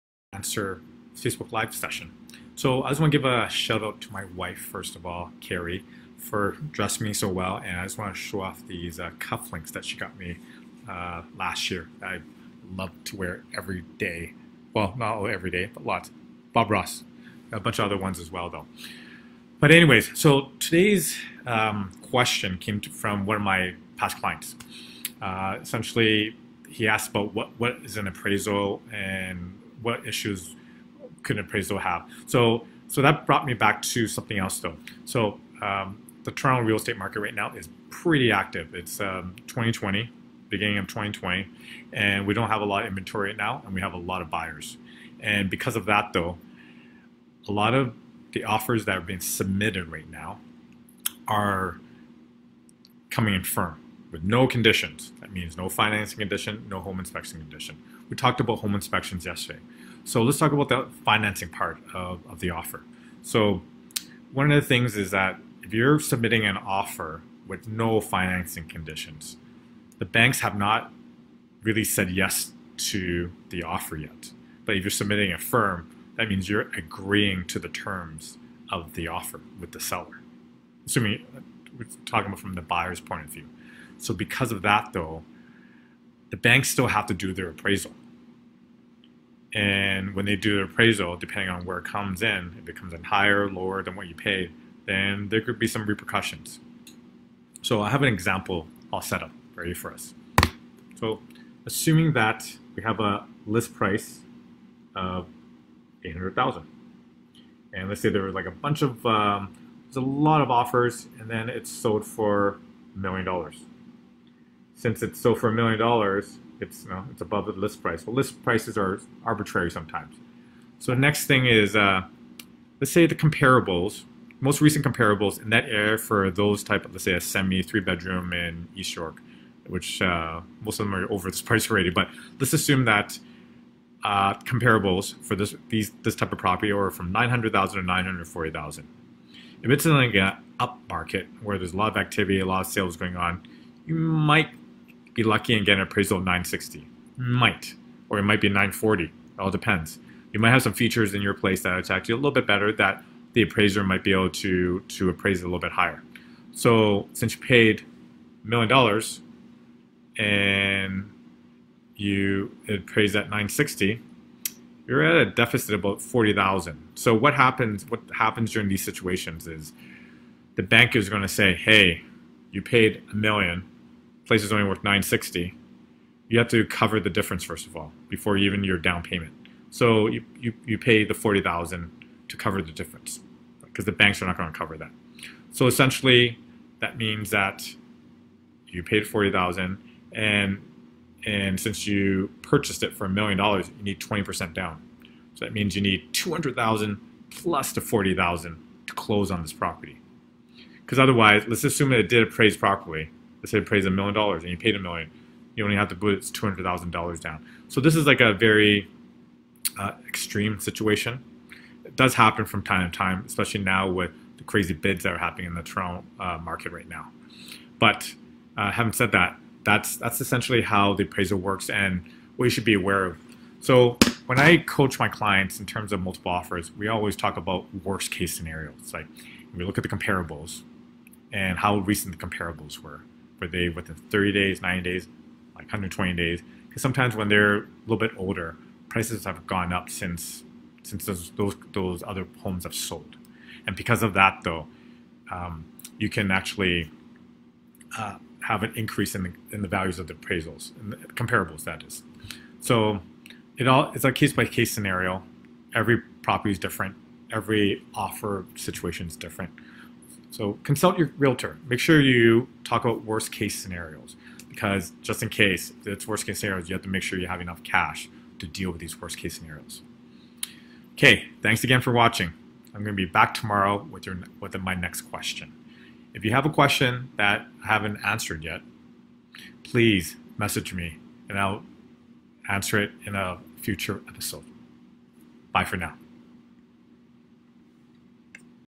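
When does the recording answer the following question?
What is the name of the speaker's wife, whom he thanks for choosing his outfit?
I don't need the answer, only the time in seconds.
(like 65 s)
5 s.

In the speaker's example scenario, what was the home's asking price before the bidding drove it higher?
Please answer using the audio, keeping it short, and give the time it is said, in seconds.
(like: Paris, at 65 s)
800,000, at 106 s.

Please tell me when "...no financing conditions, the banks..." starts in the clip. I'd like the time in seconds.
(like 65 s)
67 s.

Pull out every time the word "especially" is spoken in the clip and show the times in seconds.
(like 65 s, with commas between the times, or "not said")
213 s.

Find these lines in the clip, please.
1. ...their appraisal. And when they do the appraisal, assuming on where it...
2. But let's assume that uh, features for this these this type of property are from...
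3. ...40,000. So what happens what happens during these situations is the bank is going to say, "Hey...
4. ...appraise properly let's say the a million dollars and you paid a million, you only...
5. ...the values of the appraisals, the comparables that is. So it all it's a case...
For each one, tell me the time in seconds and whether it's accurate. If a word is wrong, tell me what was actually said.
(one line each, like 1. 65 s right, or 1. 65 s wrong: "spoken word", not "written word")
1. 87 s wrong: "depending", not "assuming"
2. 131 s wrong: "comparables", not "features"
3. 166 s right
4. 202 s right
5. 249 s right.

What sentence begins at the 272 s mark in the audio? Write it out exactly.
I'm going to be back tomorrow with your with my next question.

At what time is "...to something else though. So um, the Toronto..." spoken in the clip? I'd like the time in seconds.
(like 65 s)
33 s.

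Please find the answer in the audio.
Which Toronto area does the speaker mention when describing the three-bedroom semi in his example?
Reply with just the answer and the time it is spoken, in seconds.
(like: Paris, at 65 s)
East York, at 128 s.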